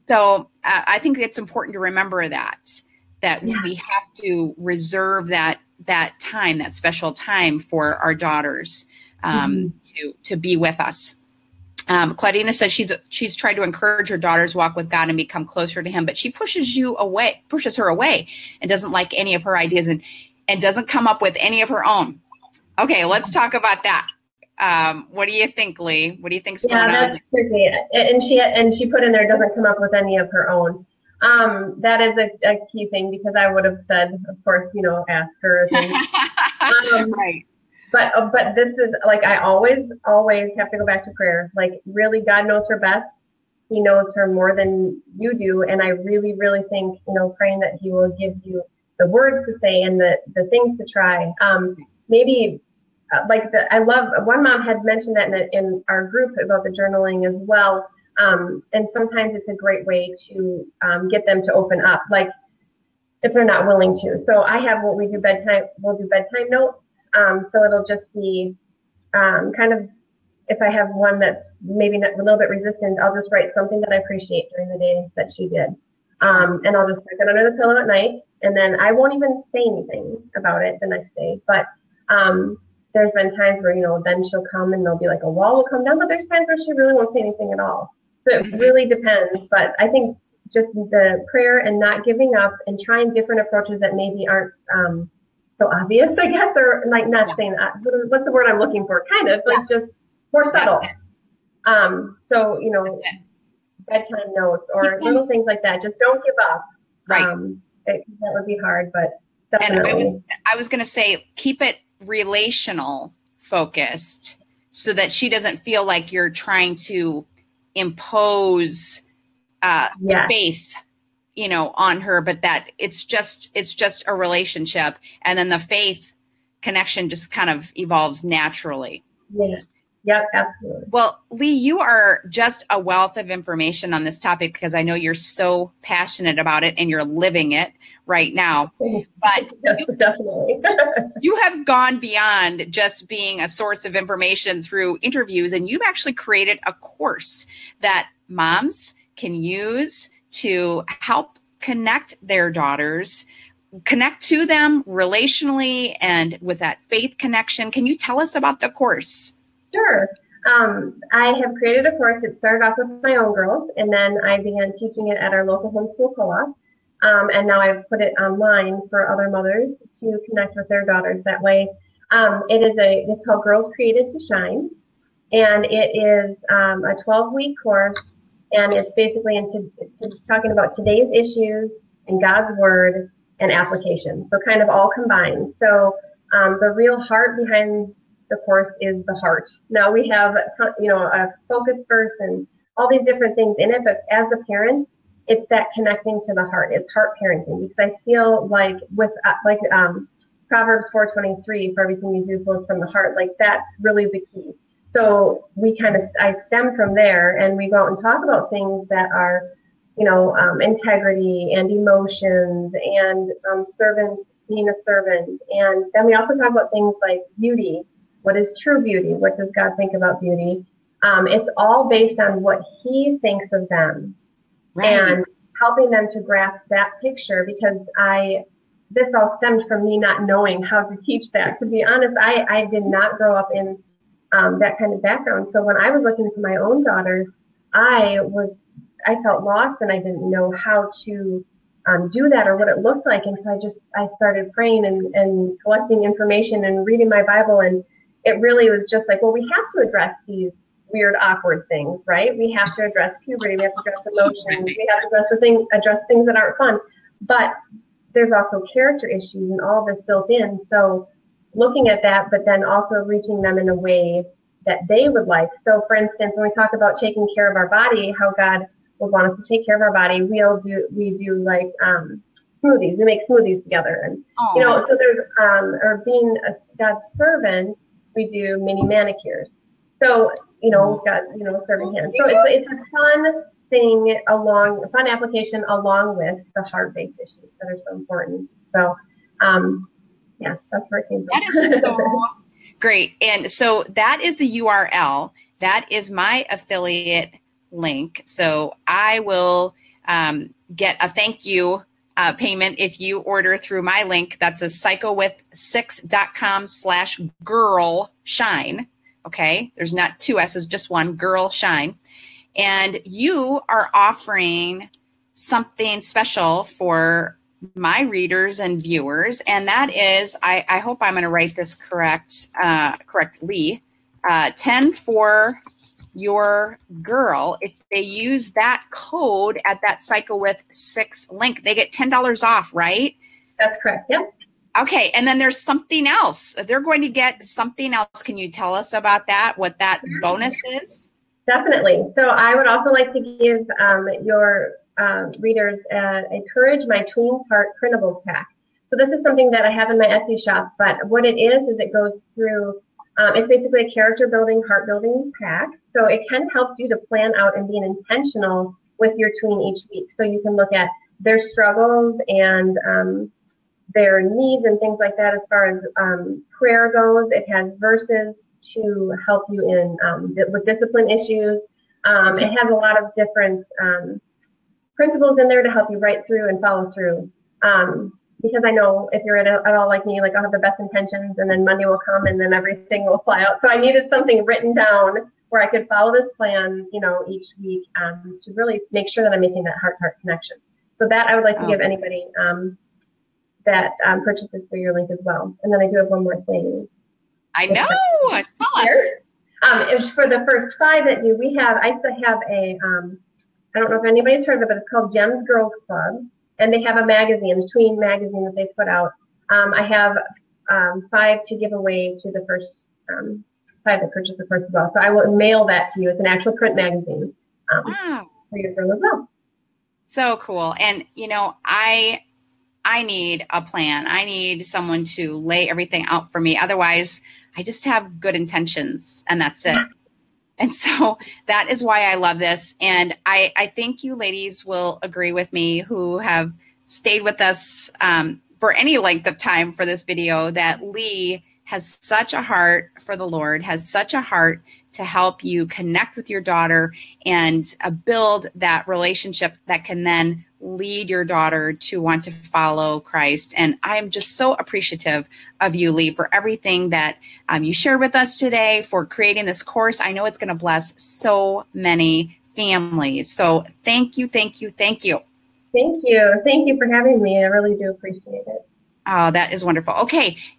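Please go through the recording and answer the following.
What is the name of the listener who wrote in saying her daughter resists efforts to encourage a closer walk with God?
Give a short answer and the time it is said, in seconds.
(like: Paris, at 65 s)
Claudina, at 12 s.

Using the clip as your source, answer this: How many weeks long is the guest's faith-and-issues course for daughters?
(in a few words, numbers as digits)
12.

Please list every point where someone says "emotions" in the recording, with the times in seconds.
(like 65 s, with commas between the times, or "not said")
211 s, 254 s.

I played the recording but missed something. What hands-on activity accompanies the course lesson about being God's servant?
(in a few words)
Mini manicures.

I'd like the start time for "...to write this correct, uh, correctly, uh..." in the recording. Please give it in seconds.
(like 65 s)
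321 s.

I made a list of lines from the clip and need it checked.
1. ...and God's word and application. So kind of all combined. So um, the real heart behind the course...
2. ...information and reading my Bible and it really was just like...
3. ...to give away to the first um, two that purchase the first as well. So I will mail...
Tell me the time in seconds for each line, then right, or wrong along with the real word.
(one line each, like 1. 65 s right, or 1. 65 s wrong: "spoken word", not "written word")
1. 182 s right
2. 246 s right
3. 411 s wrong: "five", not "two".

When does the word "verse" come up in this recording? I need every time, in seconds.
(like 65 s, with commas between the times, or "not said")
191 s, 367 s.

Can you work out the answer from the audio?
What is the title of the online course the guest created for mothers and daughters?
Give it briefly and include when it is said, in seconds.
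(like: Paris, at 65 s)
Girls Created to Shine, at 173 s.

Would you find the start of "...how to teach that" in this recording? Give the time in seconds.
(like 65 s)
230 s.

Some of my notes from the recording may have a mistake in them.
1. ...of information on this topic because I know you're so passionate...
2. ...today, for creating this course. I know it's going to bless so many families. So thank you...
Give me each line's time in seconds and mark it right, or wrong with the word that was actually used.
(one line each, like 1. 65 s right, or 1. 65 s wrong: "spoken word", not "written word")
1. 133 s right
2. 458 s right.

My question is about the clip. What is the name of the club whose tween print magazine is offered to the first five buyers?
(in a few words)
Gems Girls Club.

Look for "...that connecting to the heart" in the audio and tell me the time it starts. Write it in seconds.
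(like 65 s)
195 s.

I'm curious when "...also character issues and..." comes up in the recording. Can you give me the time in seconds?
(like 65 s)
258 s.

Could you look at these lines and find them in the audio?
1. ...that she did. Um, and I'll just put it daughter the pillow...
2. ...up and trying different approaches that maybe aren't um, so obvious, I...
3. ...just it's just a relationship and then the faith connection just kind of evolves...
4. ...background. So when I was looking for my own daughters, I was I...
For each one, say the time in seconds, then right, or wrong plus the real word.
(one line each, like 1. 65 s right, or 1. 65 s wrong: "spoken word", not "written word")
1. 75 s wrong: "under", not "daughter"
2. 92 s right
3. 123 s right
4. 235 s right.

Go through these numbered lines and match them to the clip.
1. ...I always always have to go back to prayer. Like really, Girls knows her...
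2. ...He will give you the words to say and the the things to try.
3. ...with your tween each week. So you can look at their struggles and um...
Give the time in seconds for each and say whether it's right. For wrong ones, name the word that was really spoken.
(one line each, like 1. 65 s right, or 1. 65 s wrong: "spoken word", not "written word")
1. 39 s wrong: "God", not "Girls"
2. 47 s right
3. 358 s right.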